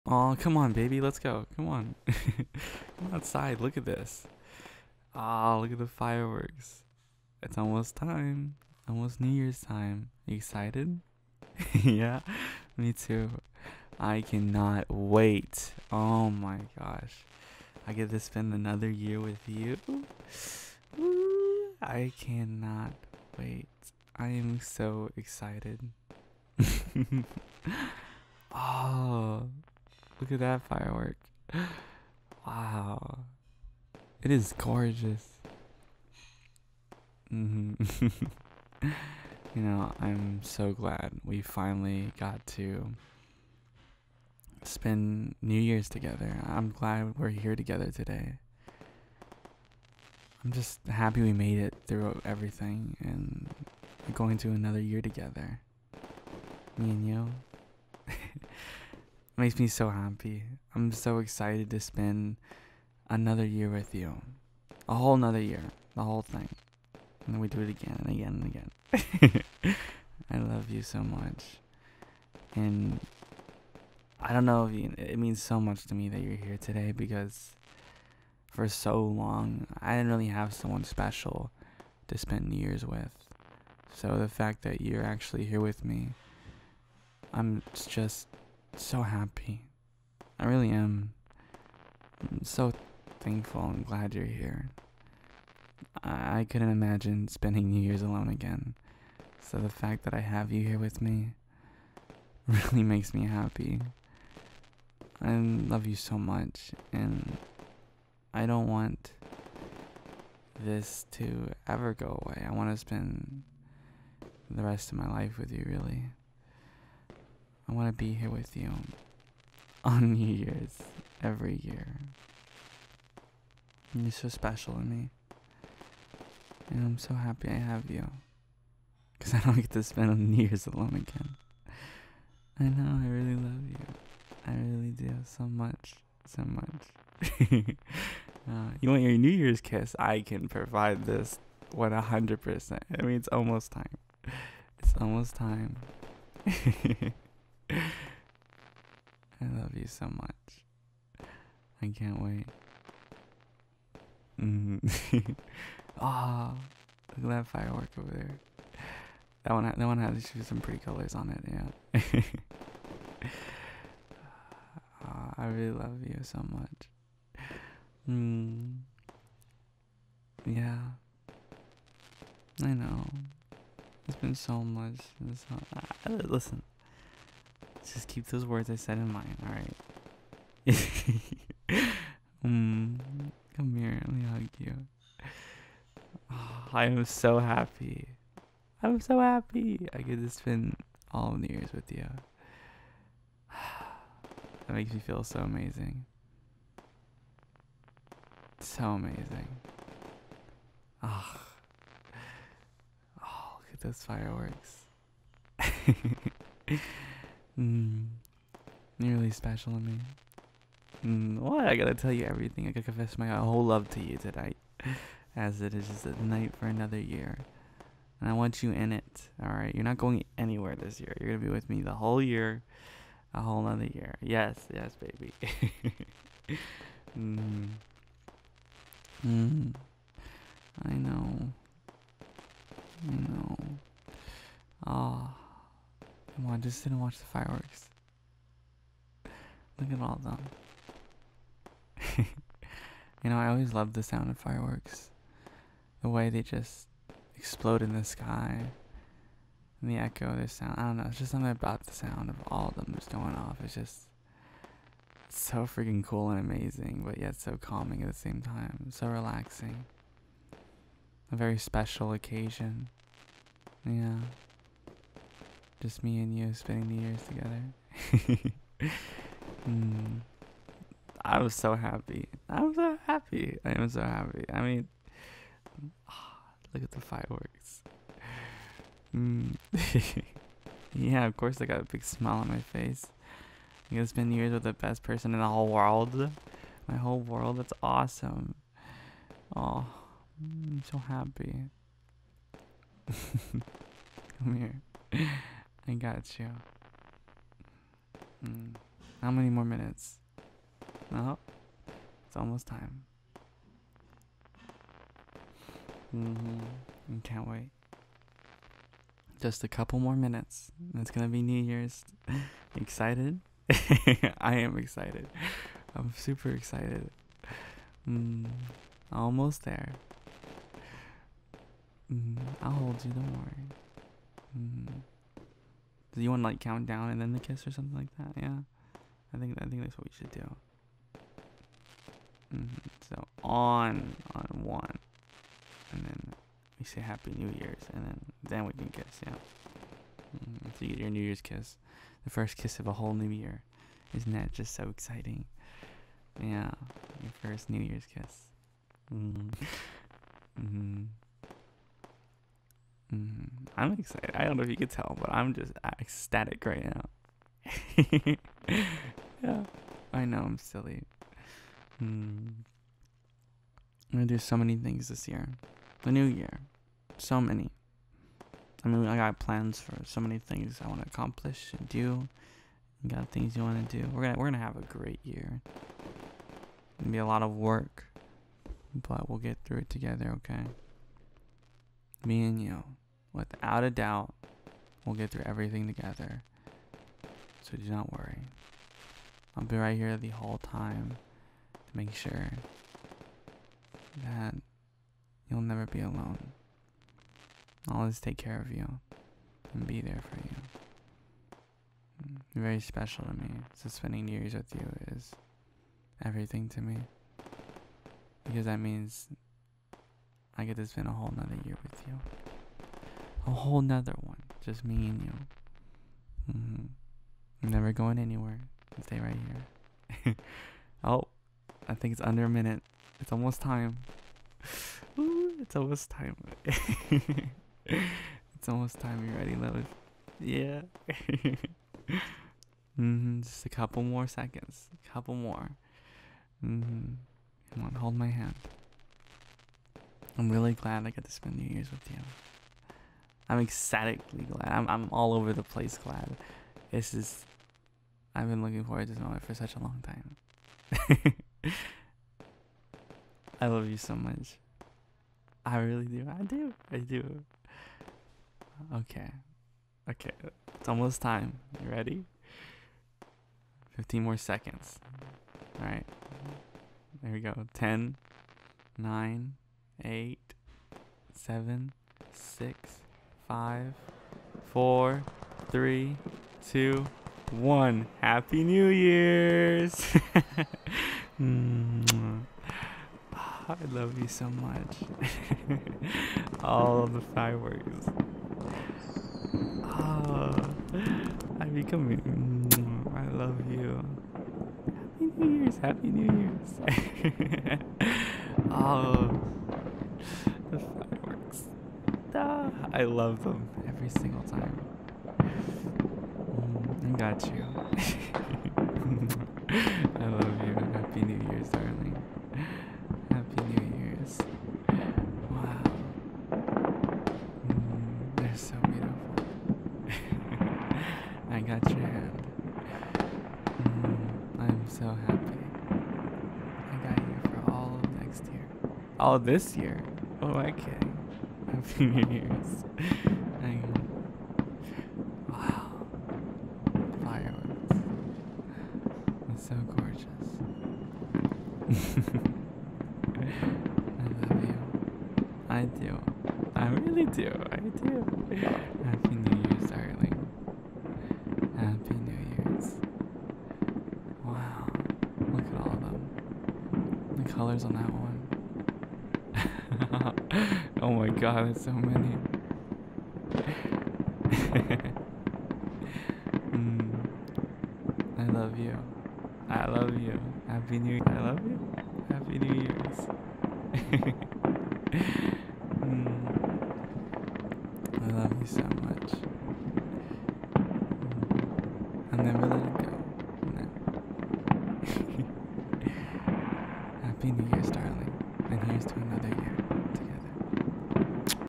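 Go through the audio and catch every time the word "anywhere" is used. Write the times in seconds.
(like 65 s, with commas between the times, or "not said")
220 s, 418 s.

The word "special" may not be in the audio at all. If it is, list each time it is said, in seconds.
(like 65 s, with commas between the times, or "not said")
80 s, 124 s, 209 s, 261 s, 402 s.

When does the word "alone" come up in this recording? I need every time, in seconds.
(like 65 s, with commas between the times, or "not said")
98 s, 130 s, 396 s.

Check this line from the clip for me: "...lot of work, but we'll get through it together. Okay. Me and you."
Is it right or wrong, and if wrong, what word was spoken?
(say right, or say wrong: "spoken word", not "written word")
right.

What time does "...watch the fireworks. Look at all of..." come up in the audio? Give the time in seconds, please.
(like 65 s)
236 s.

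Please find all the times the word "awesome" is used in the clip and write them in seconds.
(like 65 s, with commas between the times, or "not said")
287 s.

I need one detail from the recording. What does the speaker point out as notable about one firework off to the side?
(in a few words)
pretty colors.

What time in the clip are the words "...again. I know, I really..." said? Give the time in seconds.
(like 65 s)
131 s.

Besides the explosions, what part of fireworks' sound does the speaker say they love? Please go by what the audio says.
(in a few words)
The echo.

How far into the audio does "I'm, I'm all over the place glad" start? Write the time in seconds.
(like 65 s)
444 s.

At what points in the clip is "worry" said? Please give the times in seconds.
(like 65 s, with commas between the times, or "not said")
323 s, 388 s.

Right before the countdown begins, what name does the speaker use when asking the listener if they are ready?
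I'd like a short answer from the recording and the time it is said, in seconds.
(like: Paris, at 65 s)
Lois, at 429 s.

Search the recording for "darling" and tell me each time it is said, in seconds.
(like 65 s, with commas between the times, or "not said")
511 s, 549 s.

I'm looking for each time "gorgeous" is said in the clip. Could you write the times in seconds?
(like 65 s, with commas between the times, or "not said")
34 s, 539 s.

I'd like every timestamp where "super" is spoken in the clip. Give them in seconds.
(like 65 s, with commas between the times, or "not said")
316 s.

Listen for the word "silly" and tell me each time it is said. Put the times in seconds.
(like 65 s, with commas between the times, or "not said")
360 s.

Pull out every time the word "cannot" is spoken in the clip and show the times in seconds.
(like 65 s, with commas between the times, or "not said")
14 s, 22 s.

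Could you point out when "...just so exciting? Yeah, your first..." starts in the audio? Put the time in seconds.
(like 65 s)
344 s.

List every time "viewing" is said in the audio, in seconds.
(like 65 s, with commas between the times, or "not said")
not said.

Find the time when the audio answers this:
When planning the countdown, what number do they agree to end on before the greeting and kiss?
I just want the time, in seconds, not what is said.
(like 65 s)
334 s.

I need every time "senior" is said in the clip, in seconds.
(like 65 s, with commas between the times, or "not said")
531 s.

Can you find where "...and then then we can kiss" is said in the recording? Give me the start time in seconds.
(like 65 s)
337 s.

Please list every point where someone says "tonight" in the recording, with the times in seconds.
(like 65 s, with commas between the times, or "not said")
214 s.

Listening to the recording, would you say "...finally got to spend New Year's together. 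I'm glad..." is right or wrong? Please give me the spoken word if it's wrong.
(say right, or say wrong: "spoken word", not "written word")
right.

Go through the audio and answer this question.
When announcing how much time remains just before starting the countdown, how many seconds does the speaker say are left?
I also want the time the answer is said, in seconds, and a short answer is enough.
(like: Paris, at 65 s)
15, at 463 s.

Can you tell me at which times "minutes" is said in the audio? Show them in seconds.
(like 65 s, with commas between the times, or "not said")
299 s, 310 s, 422 s.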